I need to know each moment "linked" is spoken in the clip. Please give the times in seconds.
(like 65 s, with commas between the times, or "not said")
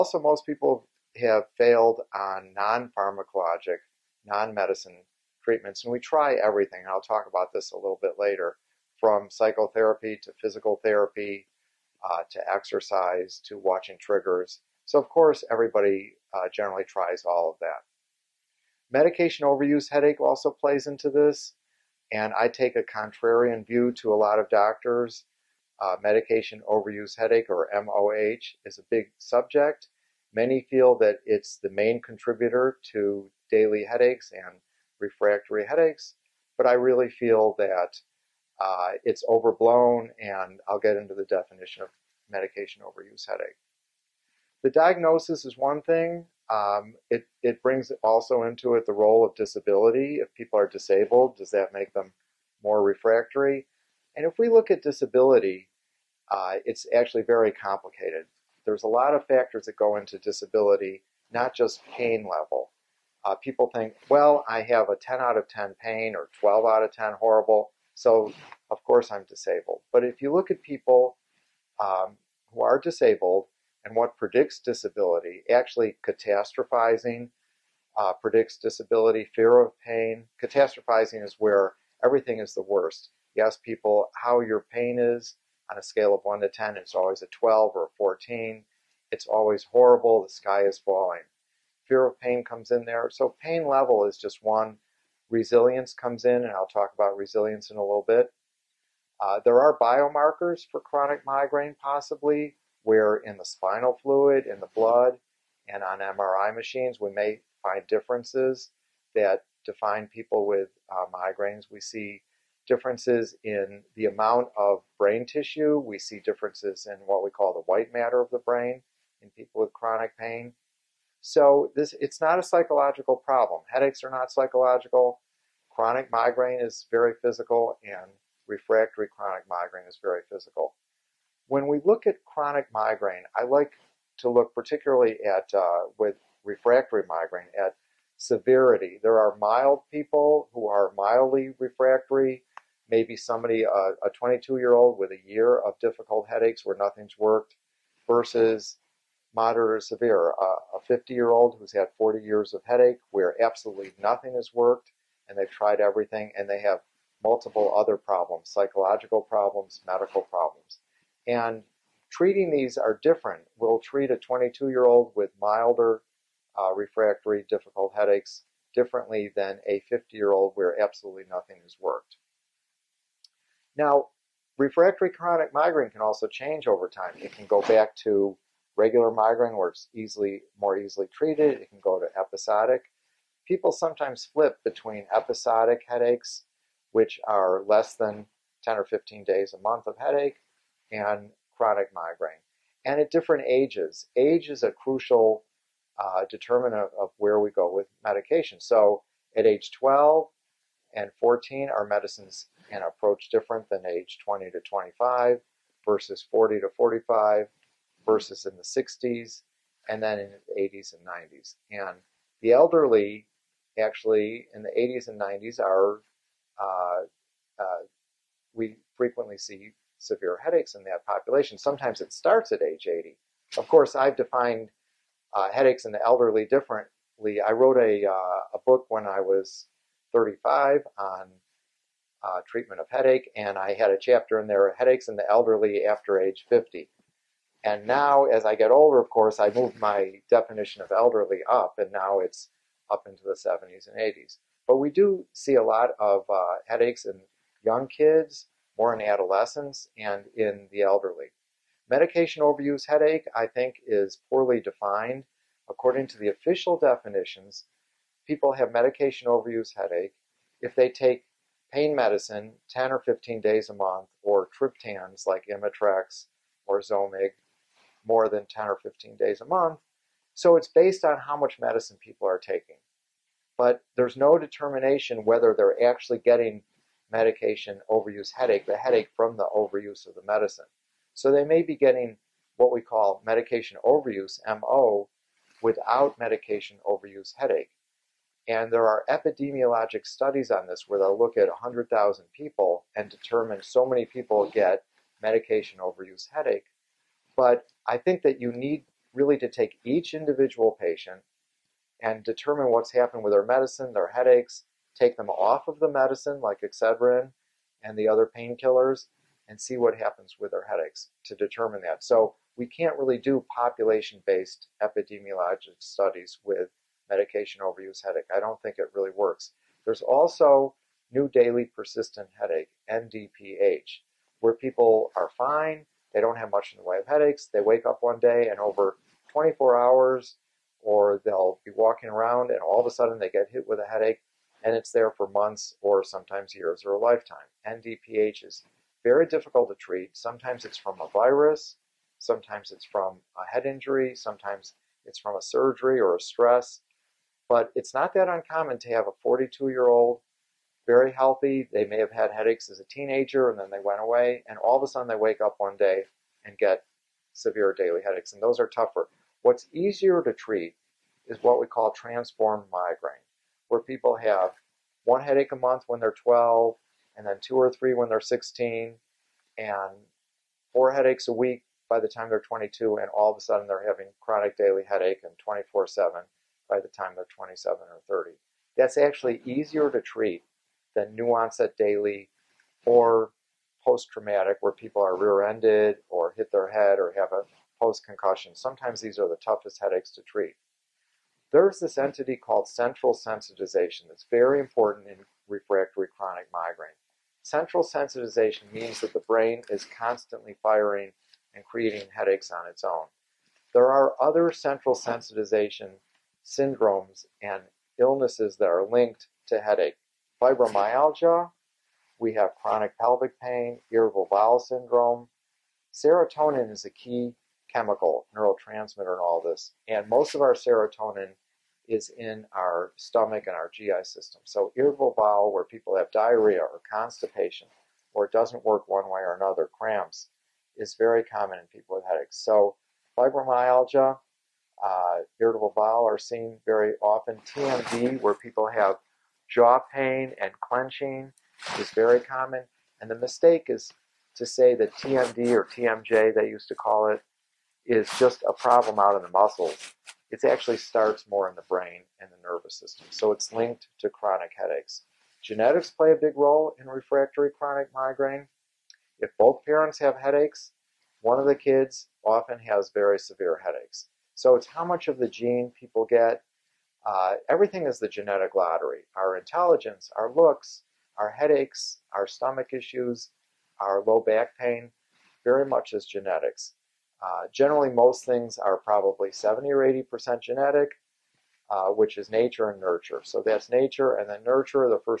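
408 s, 453 s.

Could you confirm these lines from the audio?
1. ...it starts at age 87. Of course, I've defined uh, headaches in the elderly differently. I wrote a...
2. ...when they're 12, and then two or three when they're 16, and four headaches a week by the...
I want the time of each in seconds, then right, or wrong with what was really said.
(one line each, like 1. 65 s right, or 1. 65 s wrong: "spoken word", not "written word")
1. 221 s wrong: "80", not "87"
2. 365 s right.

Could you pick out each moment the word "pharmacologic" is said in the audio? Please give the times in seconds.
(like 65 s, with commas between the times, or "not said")
2 s.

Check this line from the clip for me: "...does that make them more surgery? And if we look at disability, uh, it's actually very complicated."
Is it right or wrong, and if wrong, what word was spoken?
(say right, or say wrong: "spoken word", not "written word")
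wrong: "refractory", not "surgery".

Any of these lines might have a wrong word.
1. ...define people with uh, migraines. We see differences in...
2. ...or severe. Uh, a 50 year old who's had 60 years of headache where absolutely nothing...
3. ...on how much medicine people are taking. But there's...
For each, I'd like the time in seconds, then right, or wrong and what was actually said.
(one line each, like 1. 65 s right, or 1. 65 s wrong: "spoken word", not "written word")
1. 109 s right
2. 149 s wrong: "40", not "60"
3. 271 s right.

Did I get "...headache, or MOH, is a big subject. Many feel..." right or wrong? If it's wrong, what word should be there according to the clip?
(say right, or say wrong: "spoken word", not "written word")
right.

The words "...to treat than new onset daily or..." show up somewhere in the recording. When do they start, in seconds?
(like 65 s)
379 s.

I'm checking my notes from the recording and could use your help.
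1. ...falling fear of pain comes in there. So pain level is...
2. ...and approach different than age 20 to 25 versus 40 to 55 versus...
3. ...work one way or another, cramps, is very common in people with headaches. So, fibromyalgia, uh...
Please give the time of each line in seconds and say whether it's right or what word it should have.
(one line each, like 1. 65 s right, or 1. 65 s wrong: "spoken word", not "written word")
1. 90 s right
2. 202 s wrong: "45", not "55"
3. 428 s right.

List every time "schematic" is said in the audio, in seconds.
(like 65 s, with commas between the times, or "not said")
not said.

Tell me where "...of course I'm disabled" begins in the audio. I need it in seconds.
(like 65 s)
68 s.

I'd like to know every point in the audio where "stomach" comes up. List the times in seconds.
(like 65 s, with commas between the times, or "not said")
422 s, 472 s.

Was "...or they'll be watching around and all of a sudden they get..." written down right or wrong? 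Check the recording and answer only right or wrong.
wrong.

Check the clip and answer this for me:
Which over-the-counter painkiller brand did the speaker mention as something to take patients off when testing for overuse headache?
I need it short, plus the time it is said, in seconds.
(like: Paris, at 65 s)
Excedrin, at 306 s.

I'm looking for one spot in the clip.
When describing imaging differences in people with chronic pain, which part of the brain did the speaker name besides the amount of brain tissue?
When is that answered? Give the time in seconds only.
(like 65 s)
117 s.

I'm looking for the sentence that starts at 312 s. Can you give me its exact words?
So we can't really do population-based epidemiologic studies with medication overuse headache.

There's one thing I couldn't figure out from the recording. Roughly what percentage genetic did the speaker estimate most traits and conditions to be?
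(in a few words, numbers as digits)
70 or 80%.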